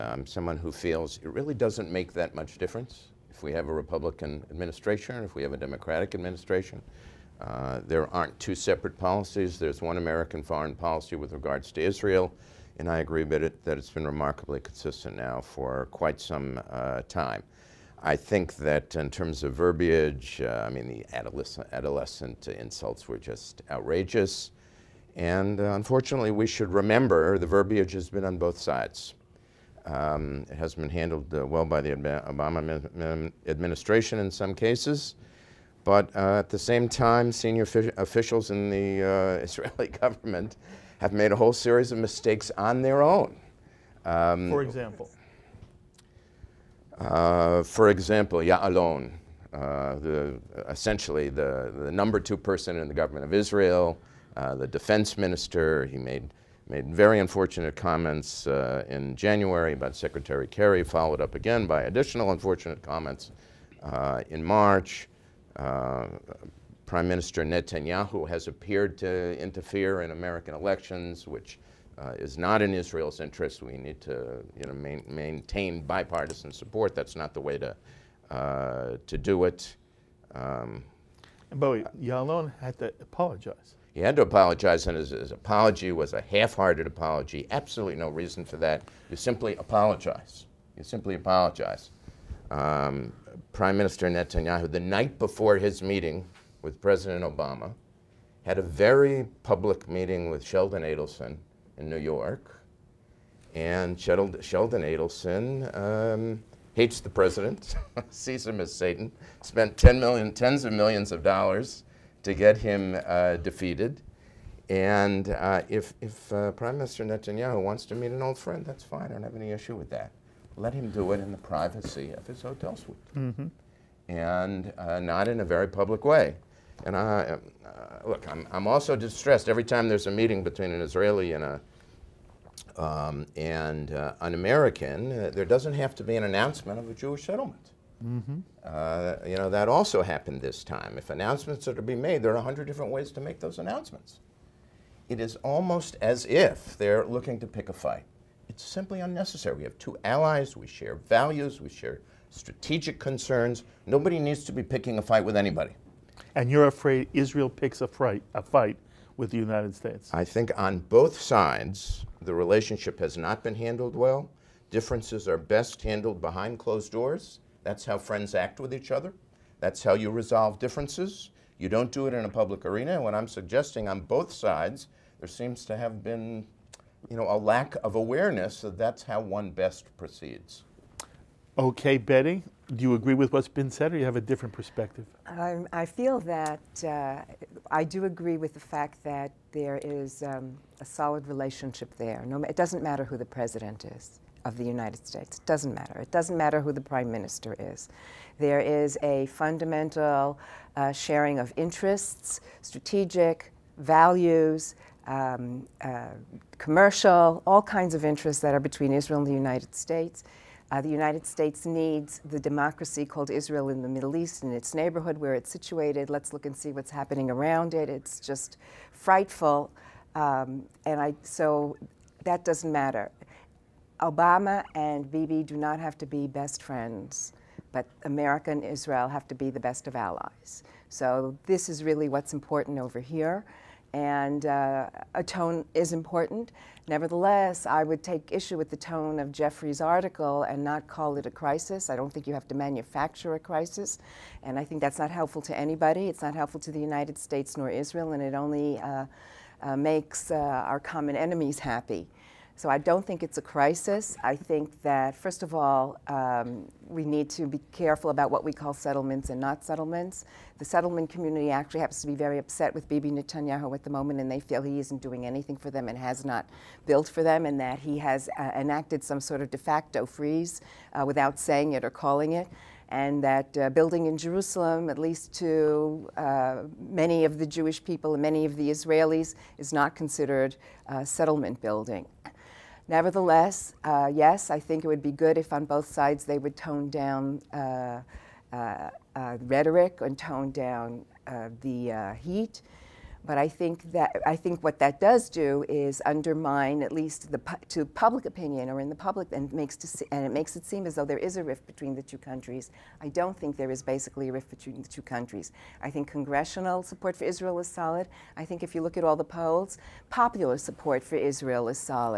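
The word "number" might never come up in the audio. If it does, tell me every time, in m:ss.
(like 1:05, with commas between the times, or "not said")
0:51.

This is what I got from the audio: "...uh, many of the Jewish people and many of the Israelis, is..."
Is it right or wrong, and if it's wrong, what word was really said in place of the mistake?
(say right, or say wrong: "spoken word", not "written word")
right.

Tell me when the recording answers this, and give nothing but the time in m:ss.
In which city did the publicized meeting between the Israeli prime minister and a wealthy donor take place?
1:41.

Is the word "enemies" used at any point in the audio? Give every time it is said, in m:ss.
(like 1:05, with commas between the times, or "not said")
4:11.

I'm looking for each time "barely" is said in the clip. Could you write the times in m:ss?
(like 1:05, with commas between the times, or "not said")
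not said.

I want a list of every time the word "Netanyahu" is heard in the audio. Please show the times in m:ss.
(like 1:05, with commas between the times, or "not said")
1:07, 1:34, 1:57, 4:23.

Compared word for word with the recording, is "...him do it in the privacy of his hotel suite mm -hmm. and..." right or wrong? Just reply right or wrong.
right.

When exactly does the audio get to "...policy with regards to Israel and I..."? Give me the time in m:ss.
0:10.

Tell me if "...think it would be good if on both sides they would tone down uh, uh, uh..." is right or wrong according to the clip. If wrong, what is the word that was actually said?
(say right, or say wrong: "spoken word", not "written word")
right.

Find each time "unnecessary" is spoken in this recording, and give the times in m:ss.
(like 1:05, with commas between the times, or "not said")
2:29.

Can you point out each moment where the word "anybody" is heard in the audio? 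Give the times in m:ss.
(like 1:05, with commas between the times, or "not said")
2:35, 4:05.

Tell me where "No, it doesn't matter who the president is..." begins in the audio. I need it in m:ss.
3:12.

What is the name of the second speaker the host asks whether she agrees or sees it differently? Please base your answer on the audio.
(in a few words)
Betty.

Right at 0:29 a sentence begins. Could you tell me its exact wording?
Um, it has been handled uh, well by the Obama administration in some cases.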